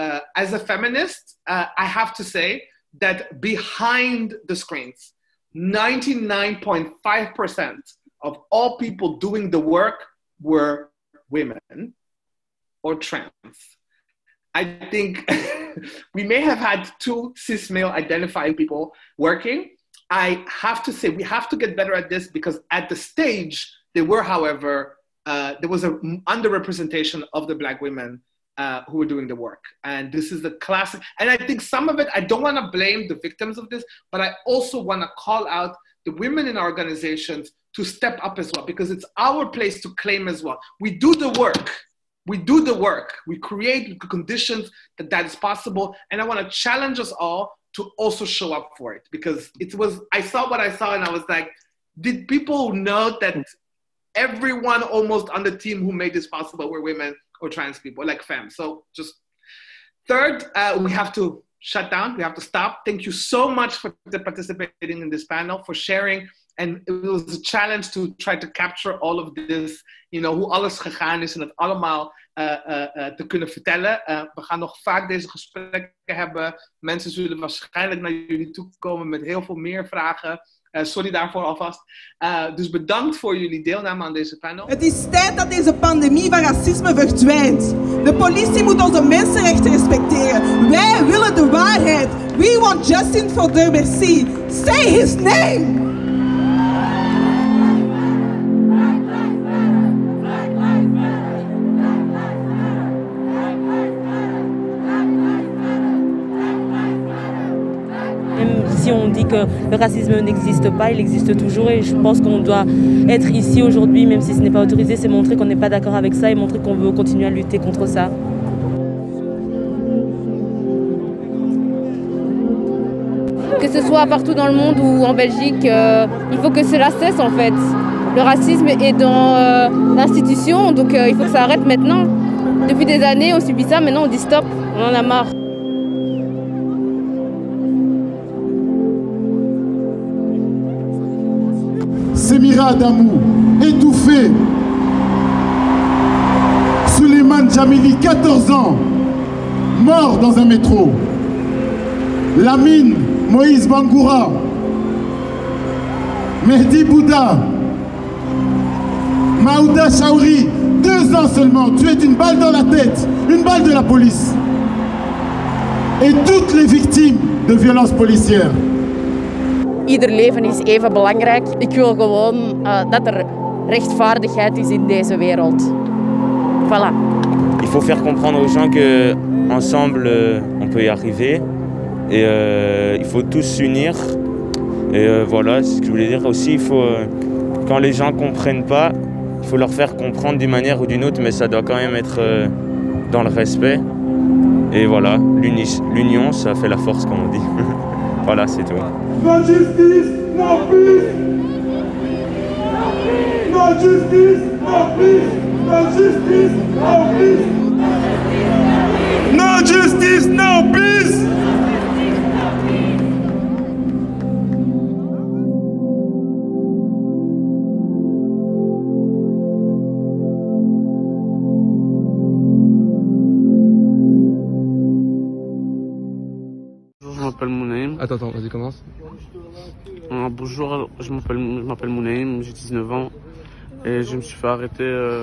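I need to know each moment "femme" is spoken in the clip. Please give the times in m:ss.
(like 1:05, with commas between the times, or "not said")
0:58.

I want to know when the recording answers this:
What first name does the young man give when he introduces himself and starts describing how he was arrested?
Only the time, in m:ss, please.
3:51.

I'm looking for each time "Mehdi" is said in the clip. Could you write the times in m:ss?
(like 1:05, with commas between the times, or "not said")
2:36.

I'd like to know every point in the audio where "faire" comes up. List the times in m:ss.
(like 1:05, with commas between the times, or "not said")
2:57, 3:09.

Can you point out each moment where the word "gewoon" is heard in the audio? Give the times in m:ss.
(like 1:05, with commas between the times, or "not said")
2:51.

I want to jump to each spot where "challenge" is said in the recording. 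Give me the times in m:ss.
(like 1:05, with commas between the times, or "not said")
0:46, 1:07.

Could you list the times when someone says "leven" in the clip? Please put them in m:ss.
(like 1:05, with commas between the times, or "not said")
2:49.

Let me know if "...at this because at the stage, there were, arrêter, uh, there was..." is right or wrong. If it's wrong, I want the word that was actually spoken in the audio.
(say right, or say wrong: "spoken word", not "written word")
wrong: "however", not "arrêter".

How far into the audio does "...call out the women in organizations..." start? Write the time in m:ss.
0:35.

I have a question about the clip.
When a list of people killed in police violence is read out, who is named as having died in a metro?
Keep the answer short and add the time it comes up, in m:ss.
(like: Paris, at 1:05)
Suleiman Jamili, at 2:26.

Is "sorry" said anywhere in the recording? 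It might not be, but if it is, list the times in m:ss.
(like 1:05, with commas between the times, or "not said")
1:20.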